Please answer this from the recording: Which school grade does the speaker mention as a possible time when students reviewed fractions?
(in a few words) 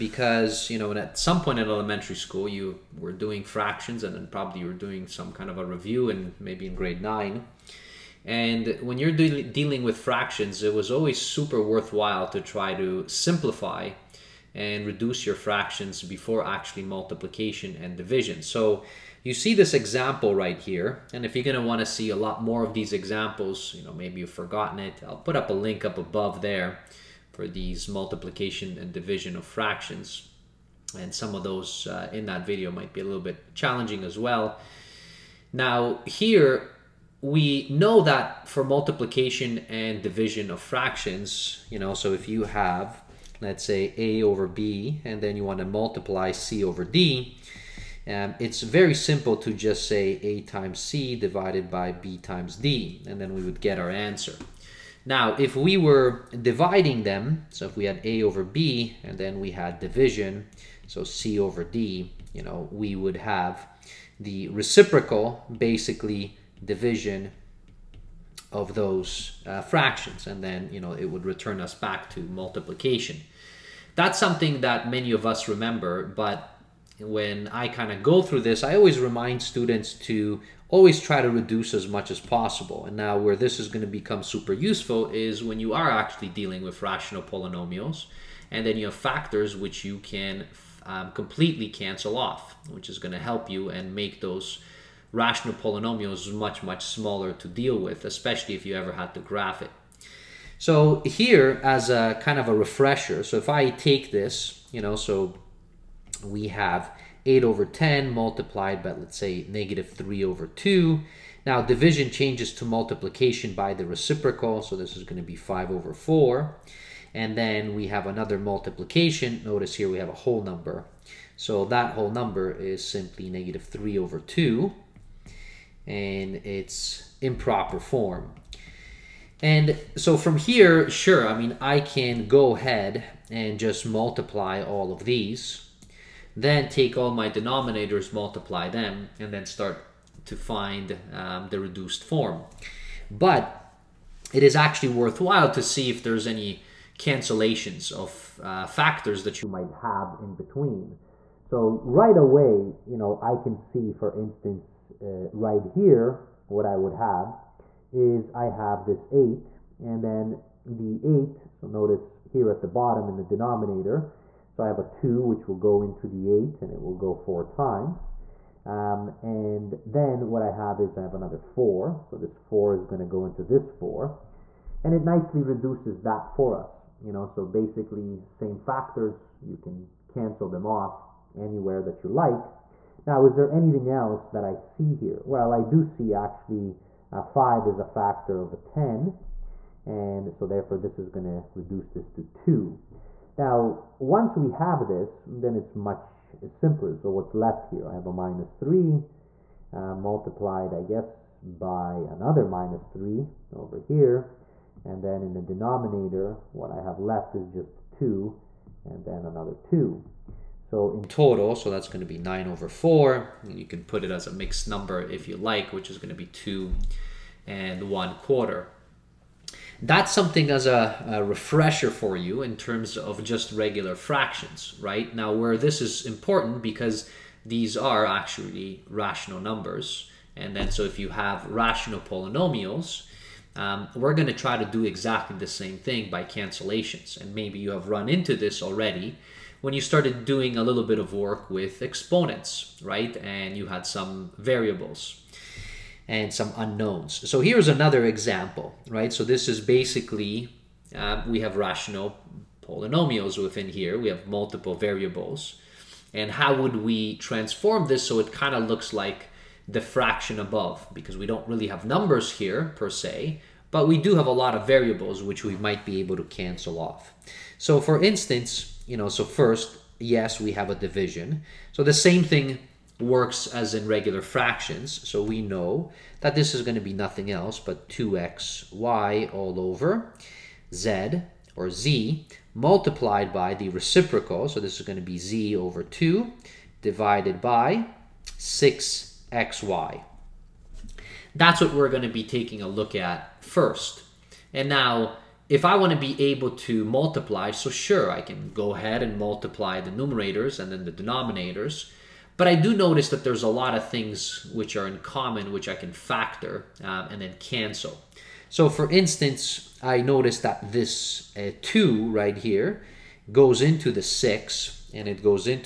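Grade 9.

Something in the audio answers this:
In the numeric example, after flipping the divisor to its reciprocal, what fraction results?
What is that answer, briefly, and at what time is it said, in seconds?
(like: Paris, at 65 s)
5/4, at 115 s.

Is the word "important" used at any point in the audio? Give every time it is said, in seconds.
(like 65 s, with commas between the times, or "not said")
226 s.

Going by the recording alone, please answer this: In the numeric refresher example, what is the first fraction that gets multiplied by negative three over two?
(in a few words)
8/10.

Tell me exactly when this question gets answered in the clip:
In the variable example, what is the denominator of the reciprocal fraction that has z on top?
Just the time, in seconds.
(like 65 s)
285 s.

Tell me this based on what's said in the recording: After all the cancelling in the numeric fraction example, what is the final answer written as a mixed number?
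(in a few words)
2 and 1/4.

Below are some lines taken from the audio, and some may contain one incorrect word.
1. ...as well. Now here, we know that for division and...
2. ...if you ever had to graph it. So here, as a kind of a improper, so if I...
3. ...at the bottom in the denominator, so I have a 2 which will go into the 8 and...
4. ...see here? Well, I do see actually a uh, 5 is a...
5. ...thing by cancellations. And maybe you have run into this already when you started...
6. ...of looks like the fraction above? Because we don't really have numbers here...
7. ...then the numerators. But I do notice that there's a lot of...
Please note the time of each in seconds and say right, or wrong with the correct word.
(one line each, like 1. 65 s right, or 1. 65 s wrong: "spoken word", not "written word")
1. 34 s wrong: "multiplication", not "division"
2. 98 s wrong: "refresher", not "improper"
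3. 162 s right
4. 184 s right
5. 235 s right
6. 258 s right
7. 300 s wrong: "denominators", not "numerators".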